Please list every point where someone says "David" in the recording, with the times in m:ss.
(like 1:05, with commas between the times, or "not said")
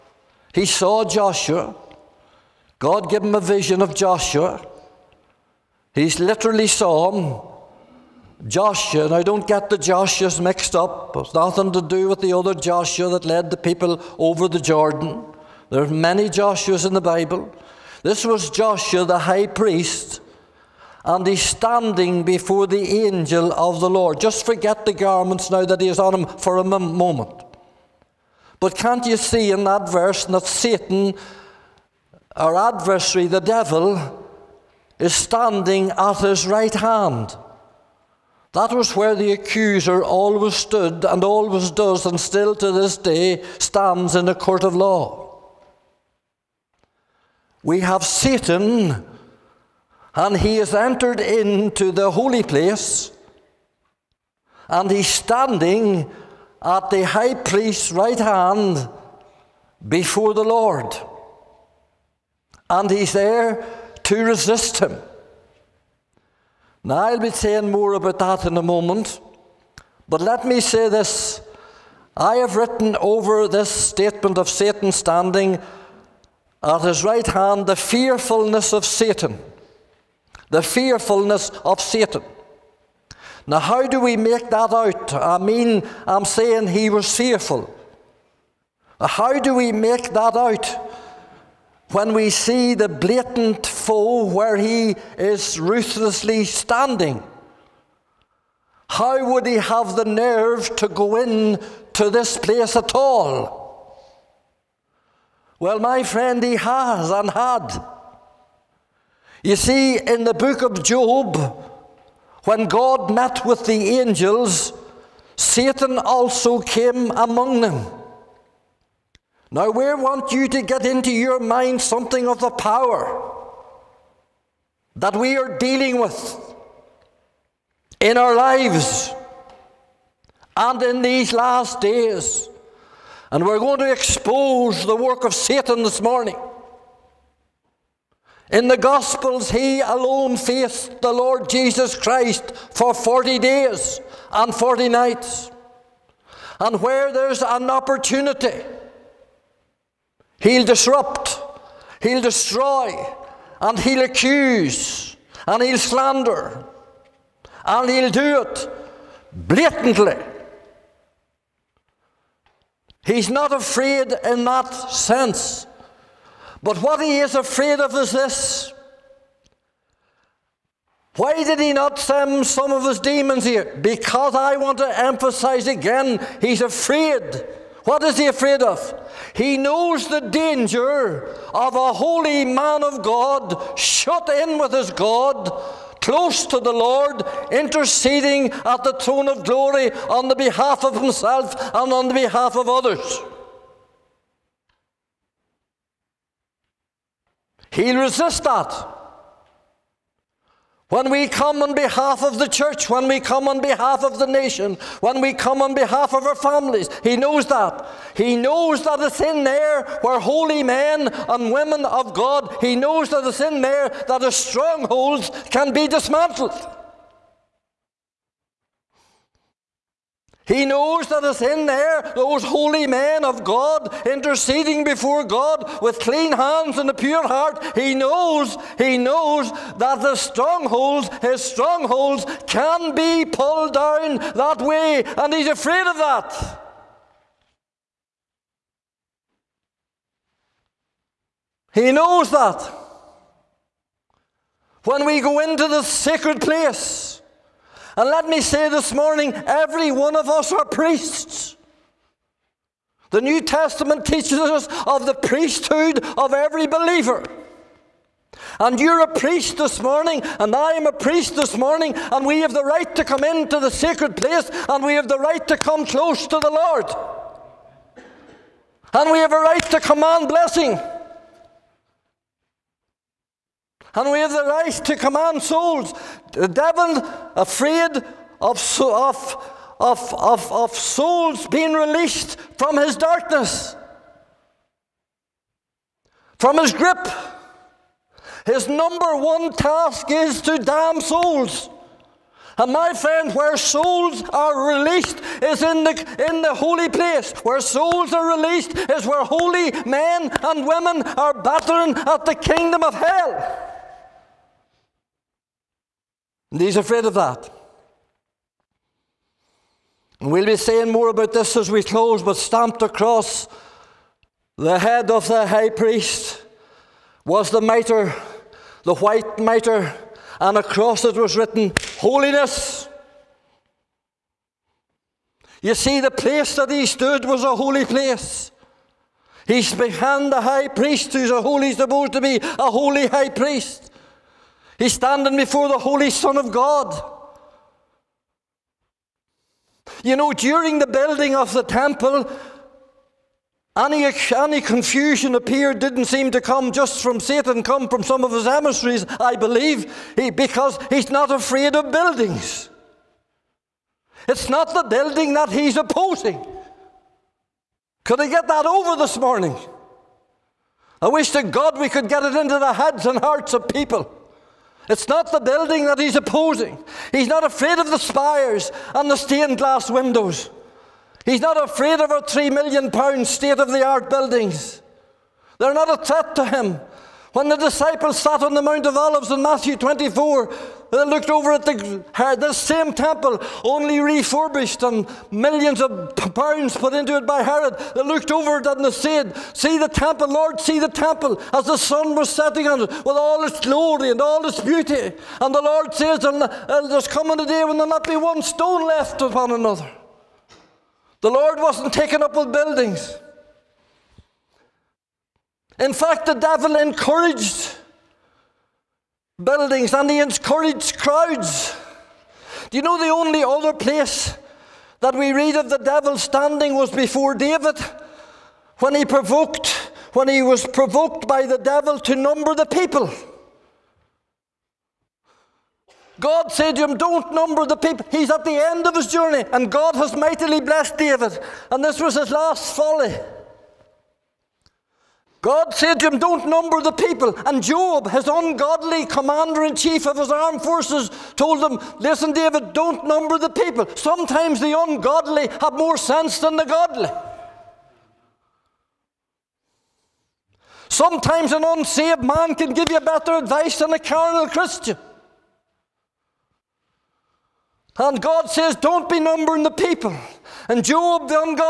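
6:57, 7:10, 7:22.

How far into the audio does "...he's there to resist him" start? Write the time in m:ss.
1:02.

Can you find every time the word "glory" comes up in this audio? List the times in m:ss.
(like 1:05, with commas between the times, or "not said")
3:09, 6:33.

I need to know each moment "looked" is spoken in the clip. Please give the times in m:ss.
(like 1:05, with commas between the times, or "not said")
6:21, 6:28.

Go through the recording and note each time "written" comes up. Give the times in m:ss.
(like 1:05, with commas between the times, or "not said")
1:12, 5:21.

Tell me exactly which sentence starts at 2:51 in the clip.
Why did he not send some of his demons here?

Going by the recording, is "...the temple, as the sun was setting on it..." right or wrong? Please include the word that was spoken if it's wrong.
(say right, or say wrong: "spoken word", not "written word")
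right.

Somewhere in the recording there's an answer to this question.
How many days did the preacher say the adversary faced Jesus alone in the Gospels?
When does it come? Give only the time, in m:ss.
2:22.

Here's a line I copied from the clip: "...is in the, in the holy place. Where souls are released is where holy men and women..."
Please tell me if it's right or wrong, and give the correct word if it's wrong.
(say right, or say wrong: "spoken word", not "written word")
right.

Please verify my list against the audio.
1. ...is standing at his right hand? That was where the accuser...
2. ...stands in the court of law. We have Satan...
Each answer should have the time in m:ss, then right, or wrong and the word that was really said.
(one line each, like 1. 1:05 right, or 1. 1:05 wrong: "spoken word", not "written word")
1. 0:34 right
2. 0:43 right.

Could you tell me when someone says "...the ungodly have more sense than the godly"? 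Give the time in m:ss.
7:24.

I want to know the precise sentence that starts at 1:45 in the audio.
Well, my friend, he has and had.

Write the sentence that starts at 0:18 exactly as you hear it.
This was Joshua, the high priest, and he's standing before the angel of the Lord.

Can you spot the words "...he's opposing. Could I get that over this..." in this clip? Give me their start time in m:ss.
5:55.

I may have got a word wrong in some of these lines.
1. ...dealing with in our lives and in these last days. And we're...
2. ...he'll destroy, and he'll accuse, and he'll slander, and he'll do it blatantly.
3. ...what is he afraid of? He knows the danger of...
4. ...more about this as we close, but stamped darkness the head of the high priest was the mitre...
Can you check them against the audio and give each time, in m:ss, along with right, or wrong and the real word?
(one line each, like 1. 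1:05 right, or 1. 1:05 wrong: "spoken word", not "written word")
1. 2:05 right
2. 2:32 right
3. 2:57 right
4. 5:10 wrong: "across", not "darkness".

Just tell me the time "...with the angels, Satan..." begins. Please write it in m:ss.
1:53.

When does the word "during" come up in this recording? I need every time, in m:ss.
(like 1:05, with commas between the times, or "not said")
5:40.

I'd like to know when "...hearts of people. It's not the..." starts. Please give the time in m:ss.
6:03.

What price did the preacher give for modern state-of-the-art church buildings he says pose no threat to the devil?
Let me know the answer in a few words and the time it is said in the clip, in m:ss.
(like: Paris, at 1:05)
3 million pounds, at 6:12.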